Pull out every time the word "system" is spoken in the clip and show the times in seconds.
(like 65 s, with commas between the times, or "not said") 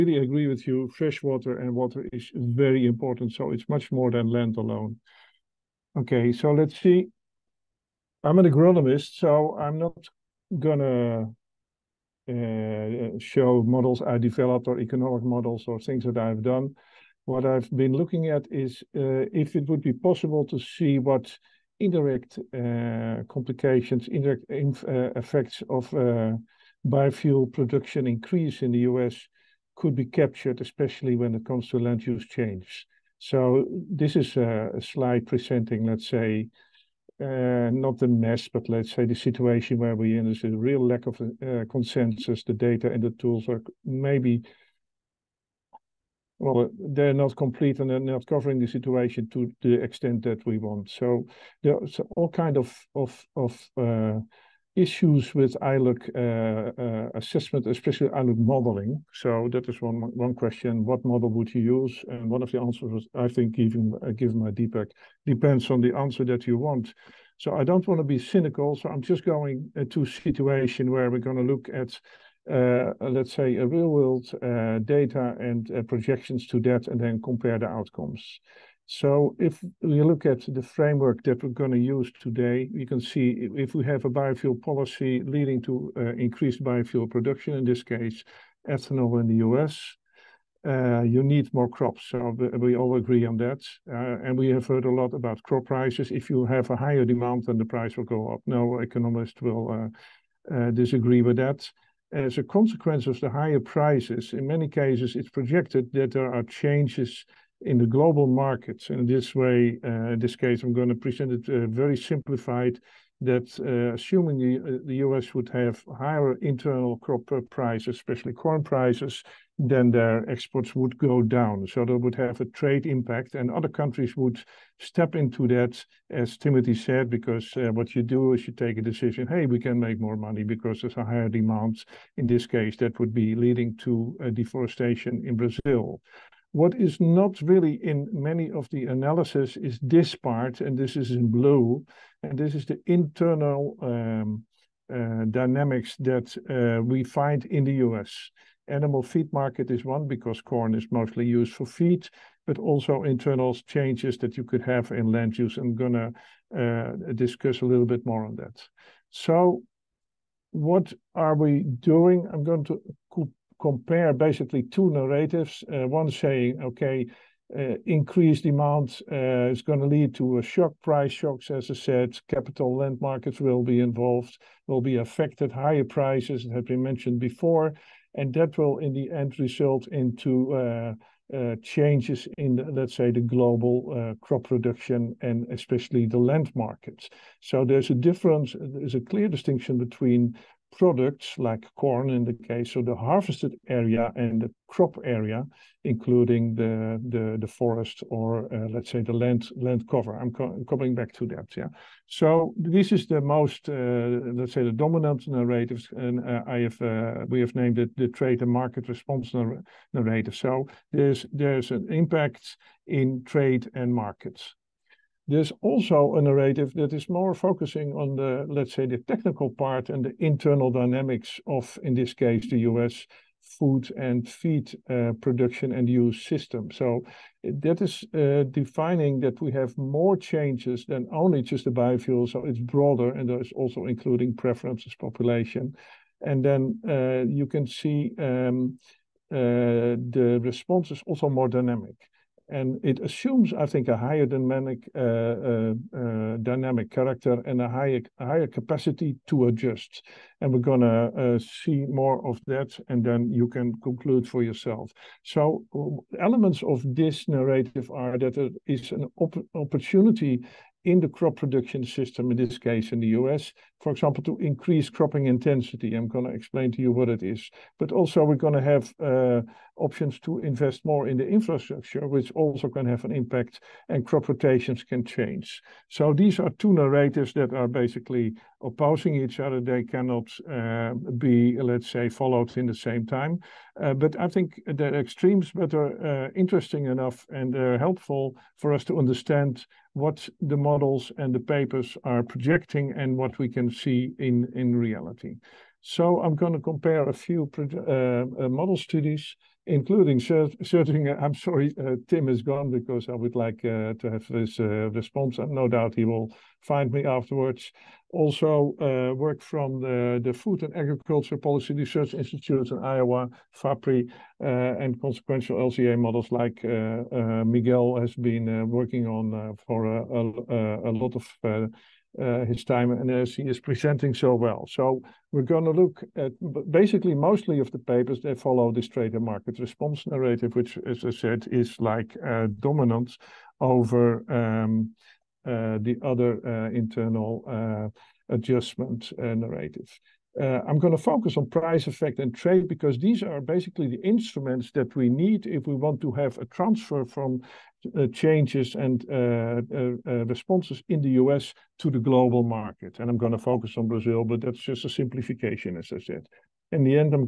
226 s, 261 s.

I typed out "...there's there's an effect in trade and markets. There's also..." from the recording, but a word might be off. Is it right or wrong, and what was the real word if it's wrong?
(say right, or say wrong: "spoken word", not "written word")
wrong: "impact", not "effect".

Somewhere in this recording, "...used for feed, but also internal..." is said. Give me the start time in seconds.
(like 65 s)
151 s.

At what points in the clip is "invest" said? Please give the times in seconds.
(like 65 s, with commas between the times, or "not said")
270 s.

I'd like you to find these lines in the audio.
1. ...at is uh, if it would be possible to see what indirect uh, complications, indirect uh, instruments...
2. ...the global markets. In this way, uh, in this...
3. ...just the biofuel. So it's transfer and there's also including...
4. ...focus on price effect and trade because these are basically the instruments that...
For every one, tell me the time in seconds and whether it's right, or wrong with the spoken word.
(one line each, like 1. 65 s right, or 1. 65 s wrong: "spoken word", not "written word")
1. 18 s wrong: "effects", not "instruments"
2. 107 s right
3. 231 s wrong: "broader", not "transfer"
4. 341 s right.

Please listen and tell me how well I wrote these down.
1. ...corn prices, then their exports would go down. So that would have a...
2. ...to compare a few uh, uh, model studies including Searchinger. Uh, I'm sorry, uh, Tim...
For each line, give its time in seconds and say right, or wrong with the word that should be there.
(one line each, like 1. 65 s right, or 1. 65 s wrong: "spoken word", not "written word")
1. 118 s right
2. 296 s right.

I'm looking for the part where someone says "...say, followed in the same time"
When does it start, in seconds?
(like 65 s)
281 s.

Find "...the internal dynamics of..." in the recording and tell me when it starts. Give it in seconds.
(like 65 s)
220 s.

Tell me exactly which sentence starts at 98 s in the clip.
No economist will disagree with that.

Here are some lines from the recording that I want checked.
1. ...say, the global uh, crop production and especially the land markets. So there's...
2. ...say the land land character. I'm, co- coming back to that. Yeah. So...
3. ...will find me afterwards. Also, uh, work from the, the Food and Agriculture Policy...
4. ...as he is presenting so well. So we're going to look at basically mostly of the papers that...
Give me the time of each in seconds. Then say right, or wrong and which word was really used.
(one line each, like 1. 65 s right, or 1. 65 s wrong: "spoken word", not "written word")
1. 182 s right
2. 198 s wrong: "cover", not "character"
3. 306 s right
4. 323 s right.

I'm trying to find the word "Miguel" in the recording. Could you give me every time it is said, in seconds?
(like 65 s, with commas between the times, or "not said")
316 s.